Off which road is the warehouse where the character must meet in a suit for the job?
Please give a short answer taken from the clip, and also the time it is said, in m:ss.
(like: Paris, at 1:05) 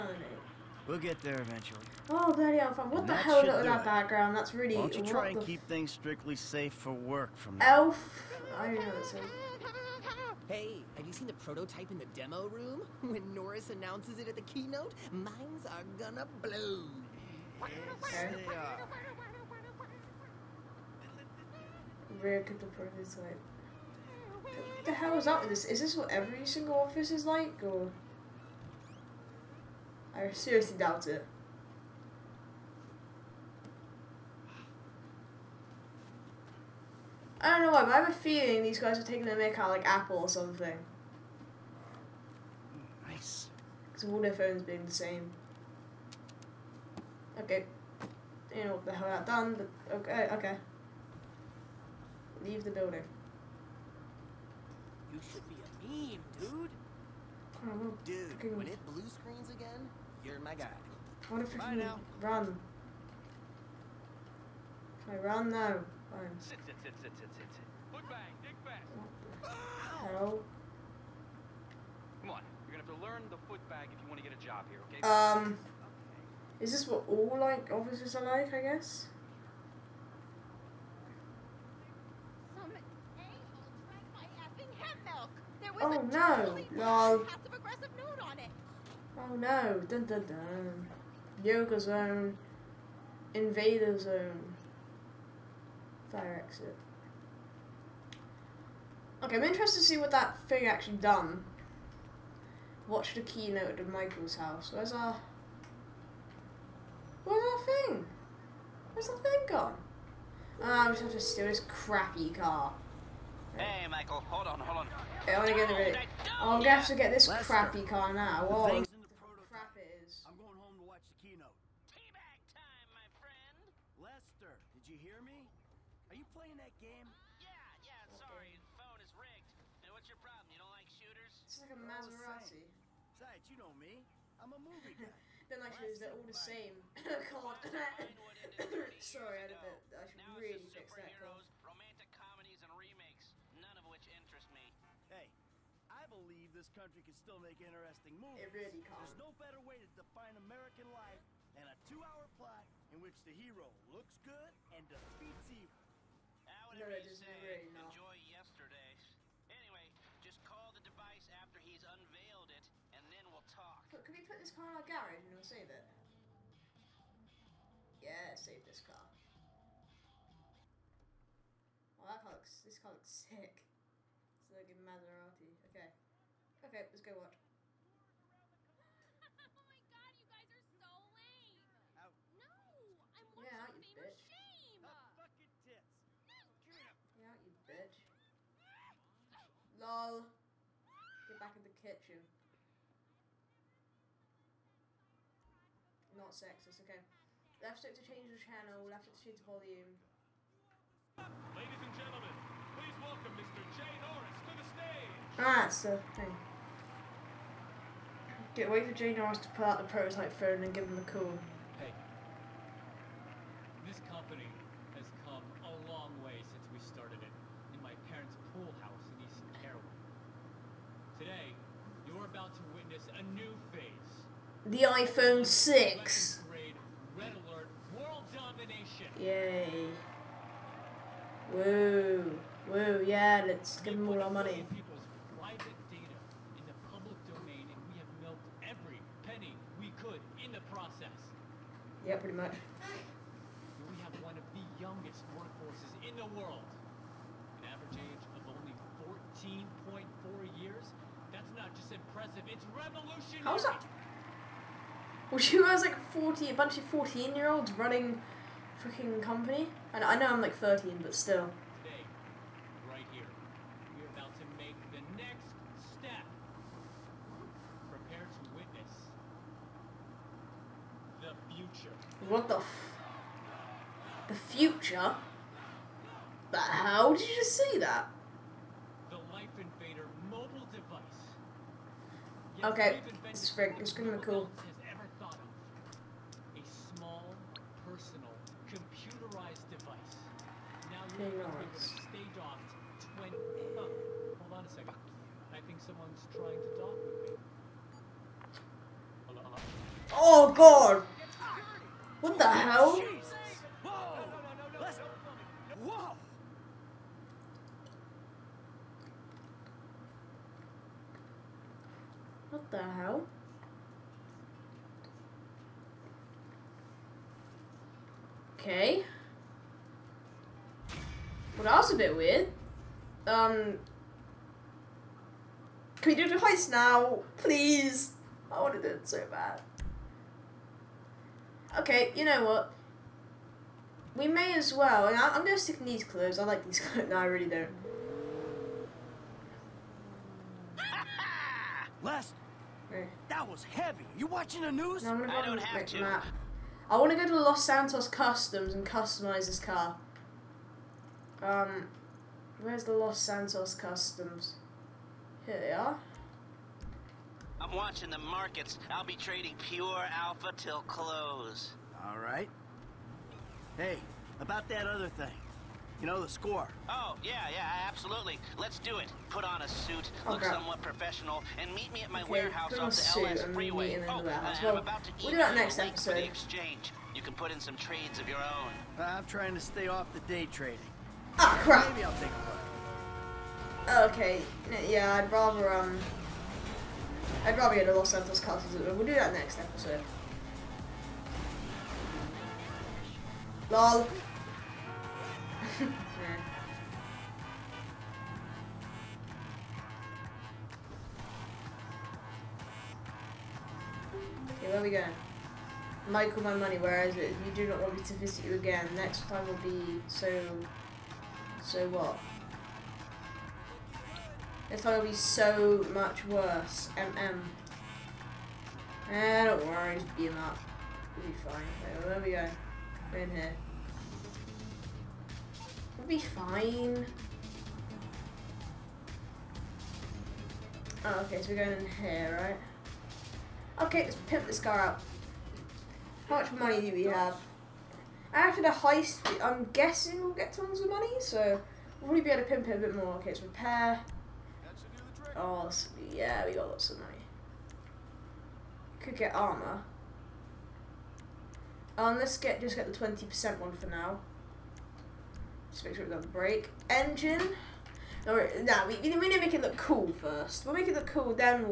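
LS freeway, at 6:13.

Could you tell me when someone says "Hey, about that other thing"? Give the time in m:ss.
6:03.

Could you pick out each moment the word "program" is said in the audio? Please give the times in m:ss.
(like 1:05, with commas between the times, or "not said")
not said.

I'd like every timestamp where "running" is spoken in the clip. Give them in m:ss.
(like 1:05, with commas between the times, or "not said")
4:17.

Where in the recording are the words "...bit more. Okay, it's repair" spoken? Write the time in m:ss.
7:22.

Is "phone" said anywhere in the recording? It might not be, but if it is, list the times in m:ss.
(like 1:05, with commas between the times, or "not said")
0:44, 2:08, 3:30.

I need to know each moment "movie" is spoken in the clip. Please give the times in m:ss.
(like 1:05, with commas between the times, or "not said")
2:14, 2:28.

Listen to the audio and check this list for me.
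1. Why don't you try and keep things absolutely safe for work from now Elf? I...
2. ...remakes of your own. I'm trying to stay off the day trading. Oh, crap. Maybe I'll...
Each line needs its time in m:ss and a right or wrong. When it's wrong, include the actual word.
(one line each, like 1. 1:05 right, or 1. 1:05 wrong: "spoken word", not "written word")
1. 0:04 wrong: "strictly", not "absolutely"
2. 6:17 wrong: "trades", not "remakes".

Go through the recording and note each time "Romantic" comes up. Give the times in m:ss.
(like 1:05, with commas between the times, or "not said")
2:21.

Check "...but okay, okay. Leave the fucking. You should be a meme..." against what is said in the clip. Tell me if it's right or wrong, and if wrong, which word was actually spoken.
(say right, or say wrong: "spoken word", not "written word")
wrong: "building", not "fucking".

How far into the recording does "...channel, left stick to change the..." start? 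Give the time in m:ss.
3:18.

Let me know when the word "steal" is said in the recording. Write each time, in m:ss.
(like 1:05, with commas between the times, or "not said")
1:51.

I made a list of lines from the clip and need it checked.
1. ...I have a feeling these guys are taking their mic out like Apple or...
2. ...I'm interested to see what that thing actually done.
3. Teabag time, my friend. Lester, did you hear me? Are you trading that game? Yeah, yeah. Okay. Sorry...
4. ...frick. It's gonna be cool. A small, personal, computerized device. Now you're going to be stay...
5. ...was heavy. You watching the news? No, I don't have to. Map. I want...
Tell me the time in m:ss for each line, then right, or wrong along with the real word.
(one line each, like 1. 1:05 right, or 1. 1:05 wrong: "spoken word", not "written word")
1. 0:37 right
2. 1:39 right
3. 2:01 wrong: "playing", not "trading"
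4. 4:43 right
5. 5:43 right.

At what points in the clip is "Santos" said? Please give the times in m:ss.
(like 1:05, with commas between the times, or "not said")
5:47, 5:53, 6:28.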